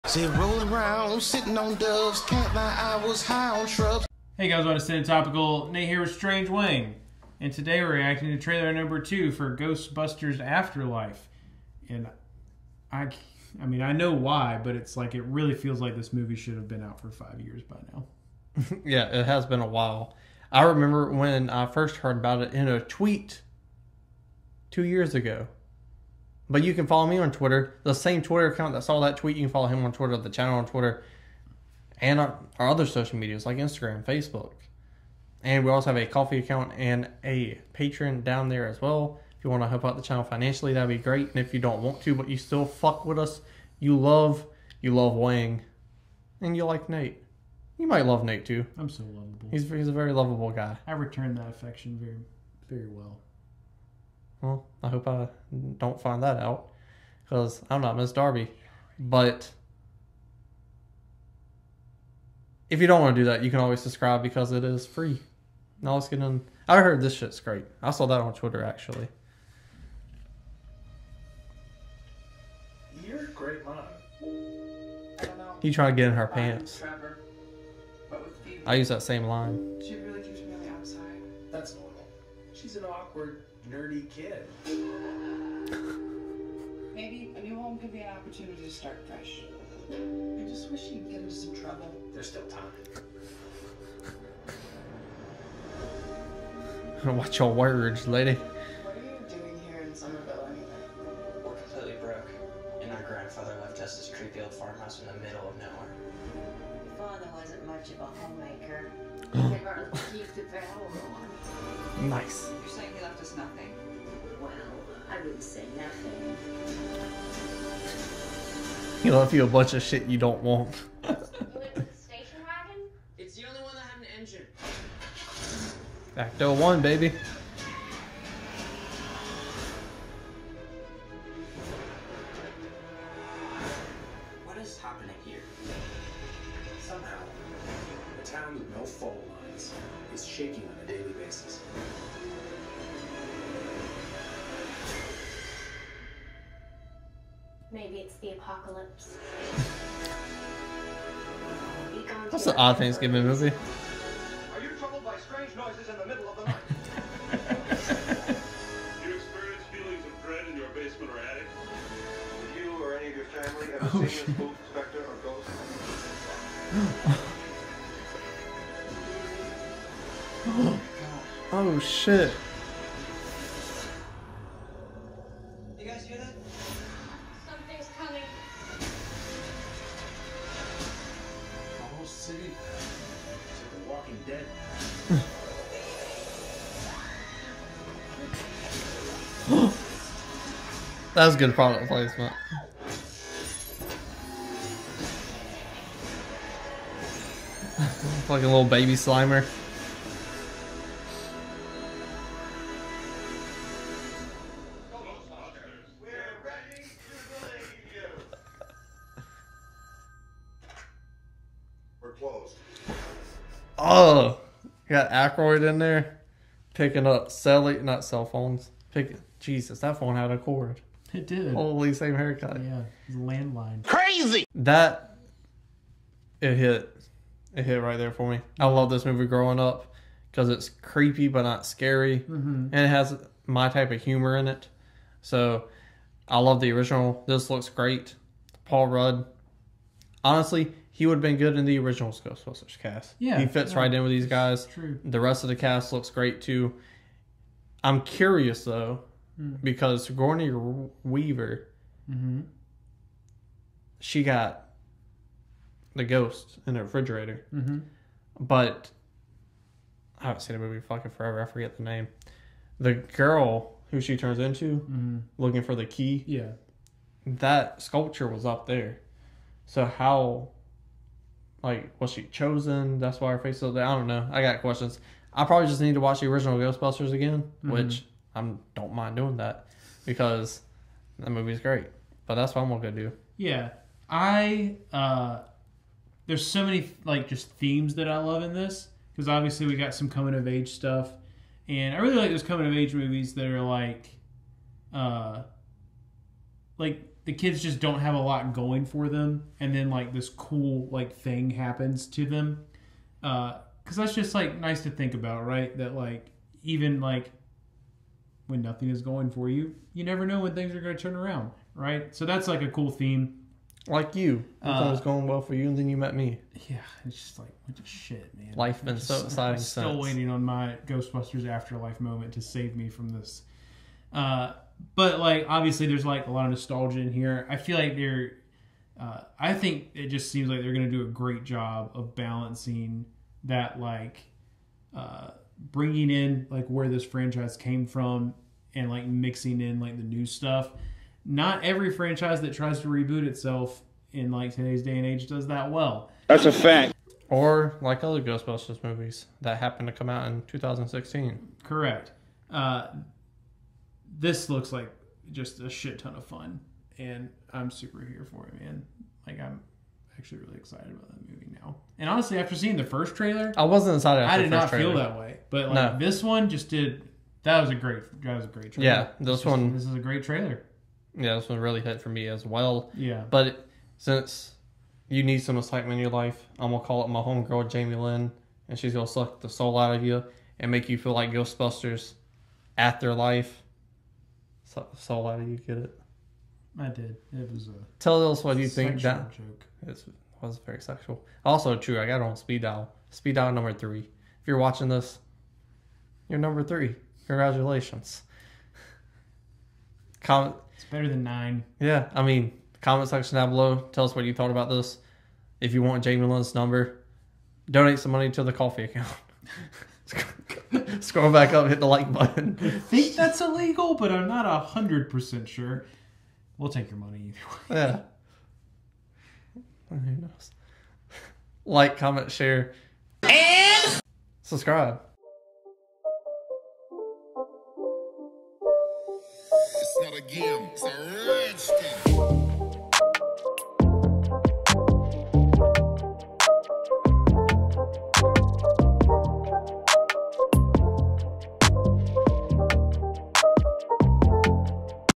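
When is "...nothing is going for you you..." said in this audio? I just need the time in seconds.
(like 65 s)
308 s.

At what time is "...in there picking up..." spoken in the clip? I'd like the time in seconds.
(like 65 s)
215 s.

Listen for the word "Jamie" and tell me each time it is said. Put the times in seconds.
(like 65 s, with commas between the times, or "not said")
377 s, 406 s.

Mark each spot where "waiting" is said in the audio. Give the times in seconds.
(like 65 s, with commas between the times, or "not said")
319 s.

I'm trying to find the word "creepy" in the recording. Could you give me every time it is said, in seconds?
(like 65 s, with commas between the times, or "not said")
104 s, 230 s.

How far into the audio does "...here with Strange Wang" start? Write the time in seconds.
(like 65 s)
5 s.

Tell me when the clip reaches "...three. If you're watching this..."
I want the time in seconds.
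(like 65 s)
393 s.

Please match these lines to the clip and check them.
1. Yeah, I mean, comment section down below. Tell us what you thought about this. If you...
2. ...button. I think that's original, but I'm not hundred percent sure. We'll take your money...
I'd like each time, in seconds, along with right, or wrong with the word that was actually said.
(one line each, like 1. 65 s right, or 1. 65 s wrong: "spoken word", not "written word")
1. 401 s right
2. 412 s wrong: "illegal", not "original".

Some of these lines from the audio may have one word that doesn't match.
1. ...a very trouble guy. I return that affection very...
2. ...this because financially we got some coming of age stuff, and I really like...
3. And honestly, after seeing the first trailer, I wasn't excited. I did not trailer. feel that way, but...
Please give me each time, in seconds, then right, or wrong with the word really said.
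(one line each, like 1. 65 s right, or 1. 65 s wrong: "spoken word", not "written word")
1. 49 s wrong: "lovable", not "trouble"
2. 288 s wrong: "obviously", not "financially"
3. 361 s right.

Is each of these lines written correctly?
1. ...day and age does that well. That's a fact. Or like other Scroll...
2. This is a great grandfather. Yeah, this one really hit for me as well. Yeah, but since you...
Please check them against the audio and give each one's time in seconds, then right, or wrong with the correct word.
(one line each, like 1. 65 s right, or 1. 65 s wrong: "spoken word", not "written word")
1. 344 s wrong: "Ghostbusters", not "Scroll"
2. 369 s wrong: "trailer", not "grandfather".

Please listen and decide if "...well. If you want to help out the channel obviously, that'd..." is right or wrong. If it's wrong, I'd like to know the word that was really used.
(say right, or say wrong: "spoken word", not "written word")
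wrong: "financially", not "obviously".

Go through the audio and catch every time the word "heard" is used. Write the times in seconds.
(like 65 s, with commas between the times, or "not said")
21 s, 66 s.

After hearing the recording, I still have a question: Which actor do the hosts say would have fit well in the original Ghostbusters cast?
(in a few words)
Paul Rudd.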